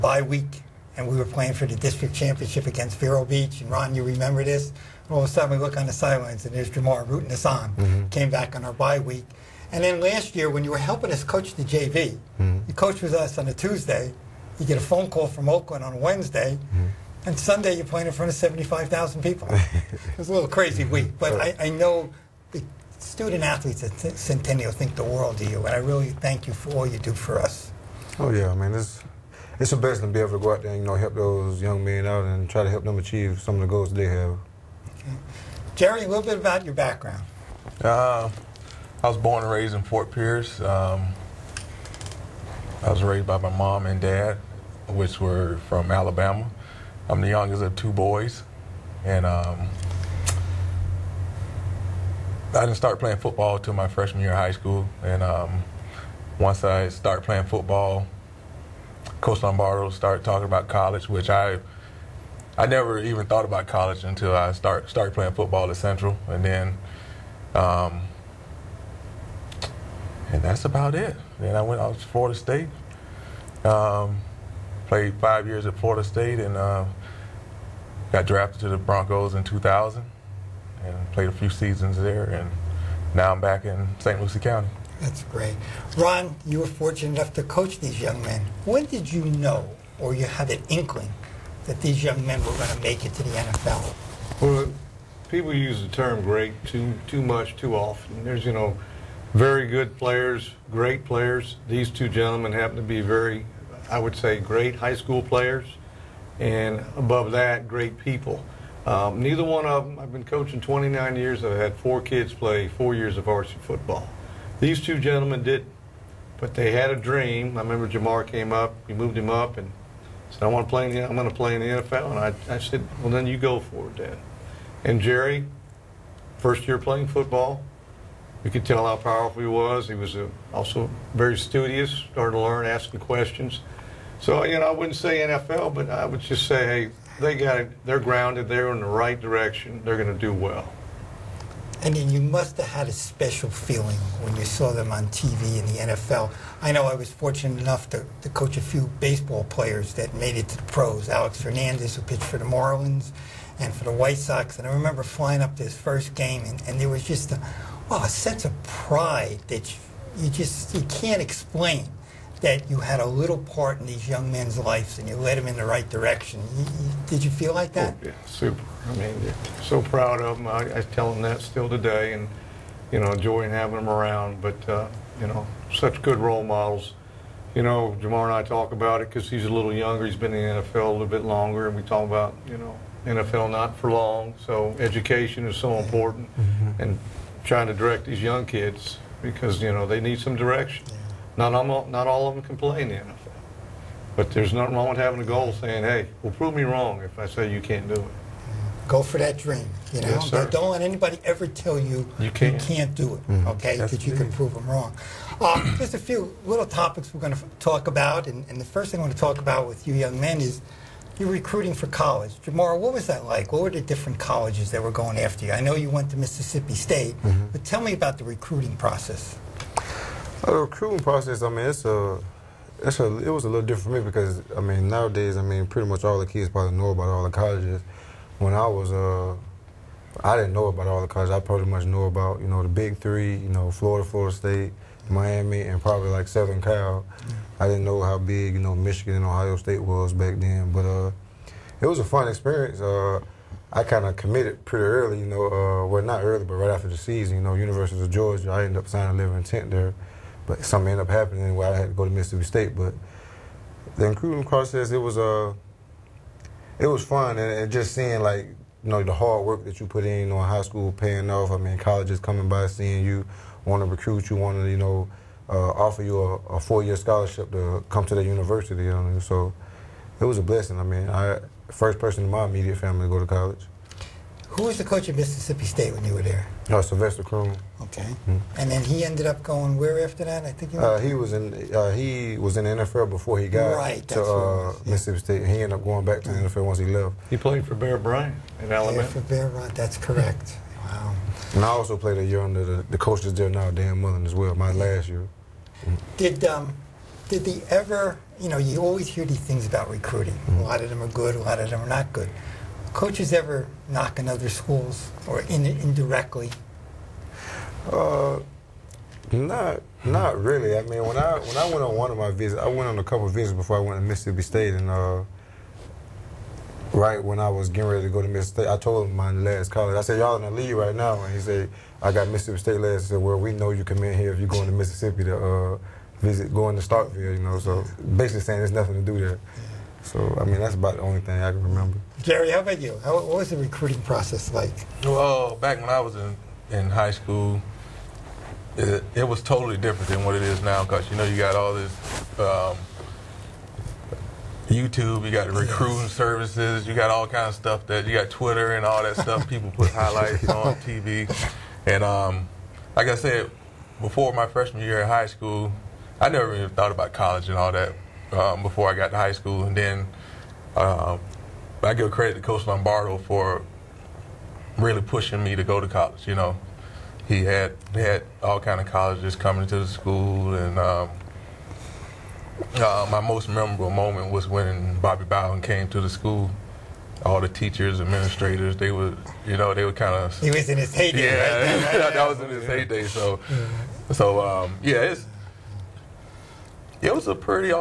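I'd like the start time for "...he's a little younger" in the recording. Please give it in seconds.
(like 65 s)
179 s.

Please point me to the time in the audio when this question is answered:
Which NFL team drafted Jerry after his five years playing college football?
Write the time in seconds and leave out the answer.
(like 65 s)
78 s.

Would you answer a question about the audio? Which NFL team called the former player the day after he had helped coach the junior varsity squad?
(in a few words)
Oakland.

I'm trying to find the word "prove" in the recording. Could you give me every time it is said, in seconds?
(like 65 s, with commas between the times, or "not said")
196 s, 204 s.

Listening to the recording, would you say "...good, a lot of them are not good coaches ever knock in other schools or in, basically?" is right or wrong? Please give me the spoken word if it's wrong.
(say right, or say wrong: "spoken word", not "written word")
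wrong: "indirectly", not "basically".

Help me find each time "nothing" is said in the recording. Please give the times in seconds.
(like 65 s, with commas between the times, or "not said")
194 s, 328 s.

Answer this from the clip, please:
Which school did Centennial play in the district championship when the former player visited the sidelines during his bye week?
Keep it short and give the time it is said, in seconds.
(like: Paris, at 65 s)
Vero Beach, at 2 s.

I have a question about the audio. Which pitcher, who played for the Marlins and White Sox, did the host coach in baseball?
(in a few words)
Alex Fernandez.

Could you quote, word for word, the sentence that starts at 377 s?
All the teachers, administrators, they were, you know, they were kind of.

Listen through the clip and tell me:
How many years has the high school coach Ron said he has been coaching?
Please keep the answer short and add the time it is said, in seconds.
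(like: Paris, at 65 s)
29, at 110 s.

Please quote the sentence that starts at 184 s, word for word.
So education is so important, mm-hmm.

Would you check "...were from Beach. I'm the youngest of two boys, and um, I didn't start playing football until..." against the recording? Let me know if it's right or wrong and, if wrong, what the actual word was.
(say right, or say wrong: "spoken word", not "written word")
wrong: "Alabama", not "Beach".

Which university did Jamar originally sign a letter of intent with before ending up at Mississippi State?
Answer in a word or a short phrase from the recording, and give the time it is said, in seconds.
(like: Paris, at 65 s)
University of Georgia, at 247 s.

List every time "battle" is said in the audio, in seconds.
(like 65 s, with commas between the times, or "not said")
not said.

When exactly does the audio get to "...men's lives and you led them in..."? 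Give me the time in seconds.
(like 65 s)
164 s.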